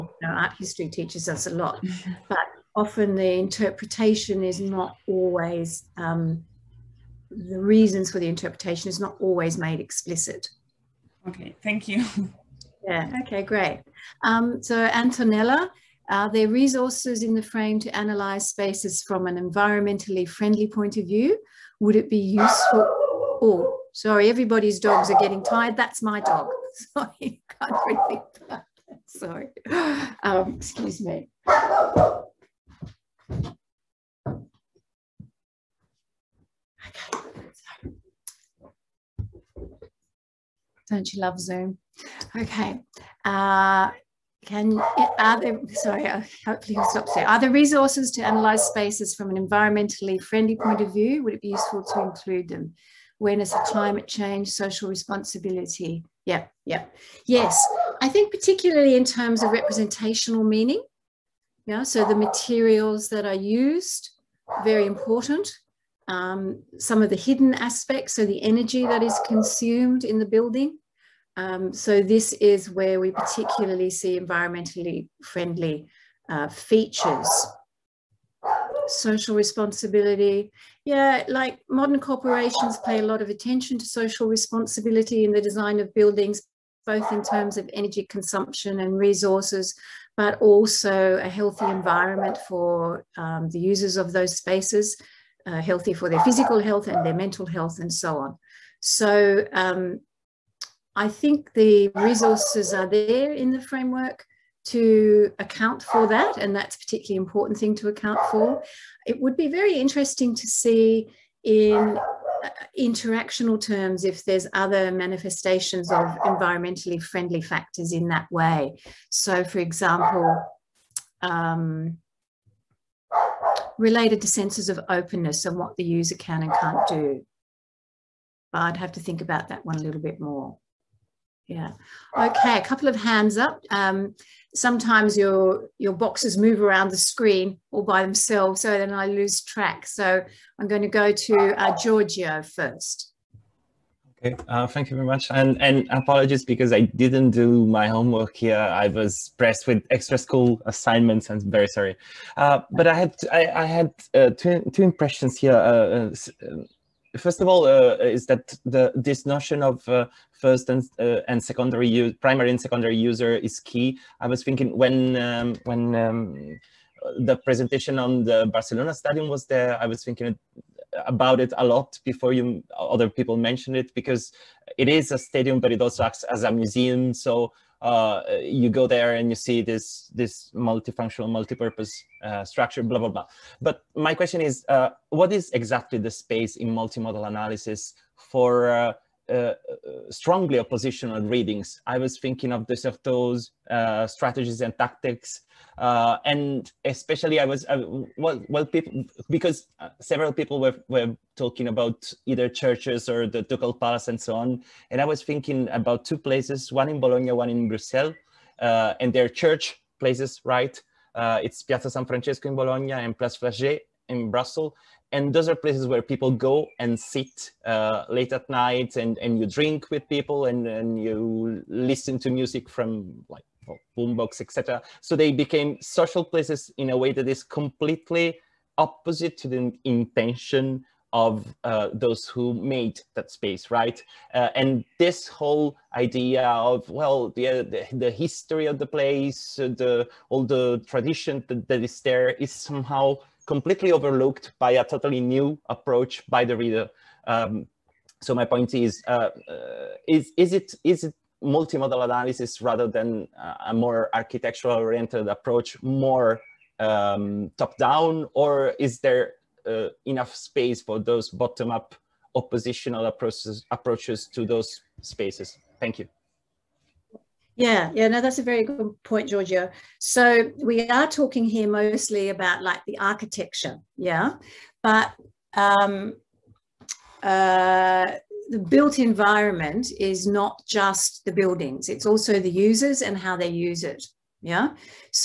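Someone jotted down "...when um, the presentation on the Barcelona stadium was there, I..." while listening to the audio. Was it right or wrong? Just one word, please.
right.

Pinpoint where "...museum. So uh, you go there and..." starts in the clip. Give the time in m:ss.
2:56.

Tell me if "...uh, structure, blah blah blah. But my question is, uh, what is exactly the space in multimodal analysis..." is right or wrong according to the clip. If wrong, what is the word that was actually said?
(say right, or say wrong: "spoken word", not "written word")
right.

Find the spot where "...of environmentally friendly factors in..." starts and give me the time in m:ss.
1:55.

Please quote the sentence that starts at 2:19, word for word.
So I'm going to go to uh, Giorgio first.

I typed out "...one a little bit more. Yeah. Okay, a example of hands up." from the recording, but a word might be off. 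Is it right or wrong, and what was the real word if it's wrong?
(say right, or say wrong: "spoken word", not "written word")
wrong: "couple", not "example".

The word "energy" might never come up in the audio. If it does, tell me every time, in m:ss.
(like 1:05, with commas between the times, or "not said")
1:08, 1:27.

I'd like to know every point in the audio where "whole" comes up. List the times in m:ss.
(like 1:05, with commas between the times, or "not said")
3:55.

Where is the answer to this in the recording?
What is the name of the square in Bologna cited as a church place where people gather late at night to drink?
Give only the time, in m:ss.
3:31.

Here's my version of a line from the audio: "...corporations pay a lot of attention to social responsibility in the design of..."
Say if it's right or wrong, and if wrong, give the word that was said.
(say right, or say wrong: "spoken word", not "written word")
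right.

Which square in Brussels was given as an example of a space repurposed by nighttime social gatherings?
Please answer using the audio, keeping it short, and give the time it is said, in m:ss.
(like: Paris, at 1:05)
Place Flagey, at 3:33.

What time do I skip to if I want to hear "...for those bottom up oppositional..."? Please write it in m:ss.
4:20.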